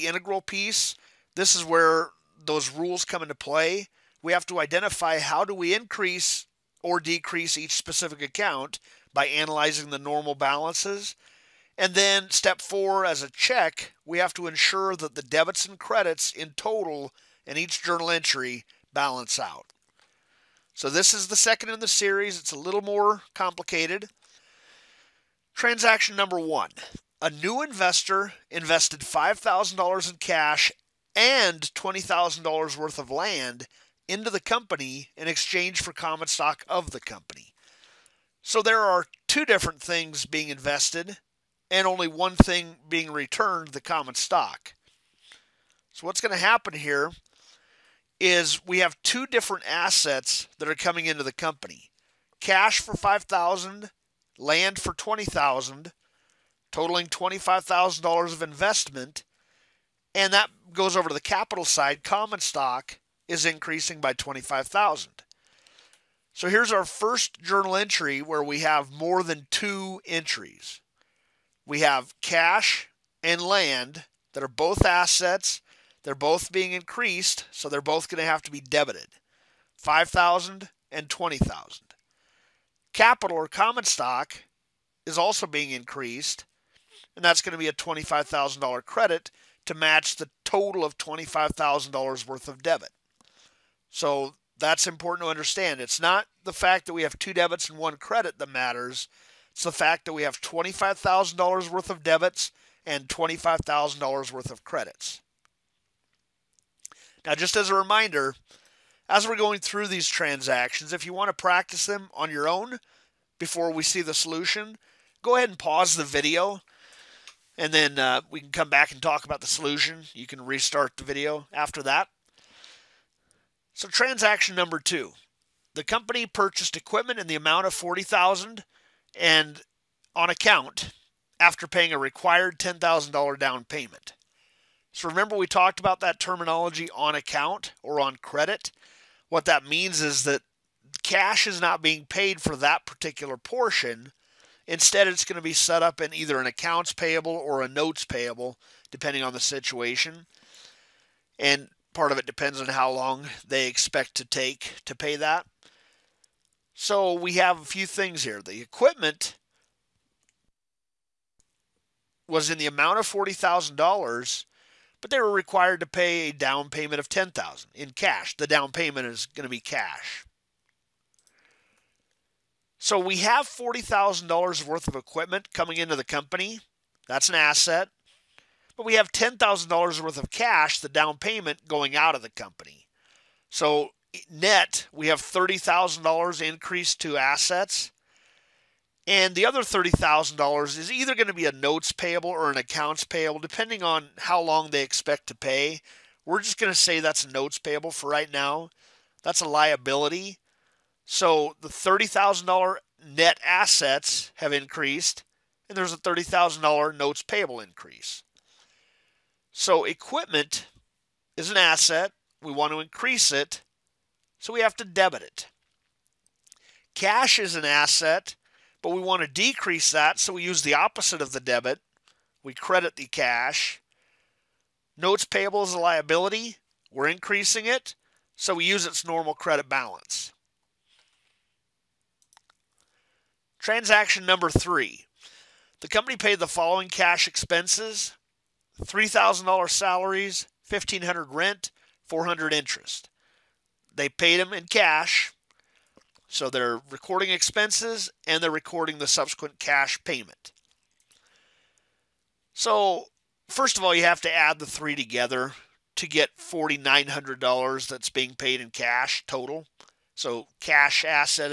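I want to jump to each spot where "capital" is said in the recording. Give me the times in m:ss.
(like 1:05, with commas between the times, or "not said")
1:01, 1:22.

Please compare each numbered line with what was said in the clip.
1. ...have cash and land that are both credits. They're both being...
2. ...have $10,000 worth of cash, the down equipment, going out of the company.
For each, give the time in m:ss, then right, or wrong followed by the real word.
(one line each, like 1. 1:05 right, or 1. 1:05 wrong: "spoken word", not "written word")
1. 1:11 wrong: "assets", not "credits"
2. 2:58 wrong: "payment", not "equipment".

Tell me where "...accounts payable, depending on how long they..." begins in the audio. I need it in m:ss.
3:12.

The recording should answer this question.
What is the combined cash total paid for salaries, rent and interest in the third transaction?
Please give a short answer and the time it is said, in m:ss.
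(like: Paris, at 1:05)
$4,900, at 4:16.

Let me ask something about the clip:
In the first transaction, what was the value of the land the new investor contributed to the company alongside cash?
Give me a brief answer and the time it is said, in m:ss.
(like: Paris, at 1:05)
$20,000, at 0:31.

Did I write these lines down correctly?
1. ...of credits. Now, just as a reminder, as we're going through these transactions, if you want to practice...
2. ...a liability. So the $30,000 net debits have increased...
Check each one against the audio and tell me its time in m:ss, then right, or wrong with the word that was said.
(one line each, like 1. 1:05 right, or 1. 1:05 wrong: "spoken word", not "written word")
1. 1:44 right
2. 3:19 wrong: "assets", not "debits".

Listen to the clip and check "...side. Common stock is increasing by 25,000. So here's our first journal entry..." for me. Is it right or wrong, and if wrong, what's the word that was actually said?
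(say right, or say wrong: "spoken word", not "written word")
right.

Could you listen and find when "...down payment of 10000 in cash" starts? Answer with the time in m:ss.
2:46.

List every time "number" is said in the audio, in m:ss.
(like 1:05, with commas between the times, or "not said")
0:26, 2:04, 3:54.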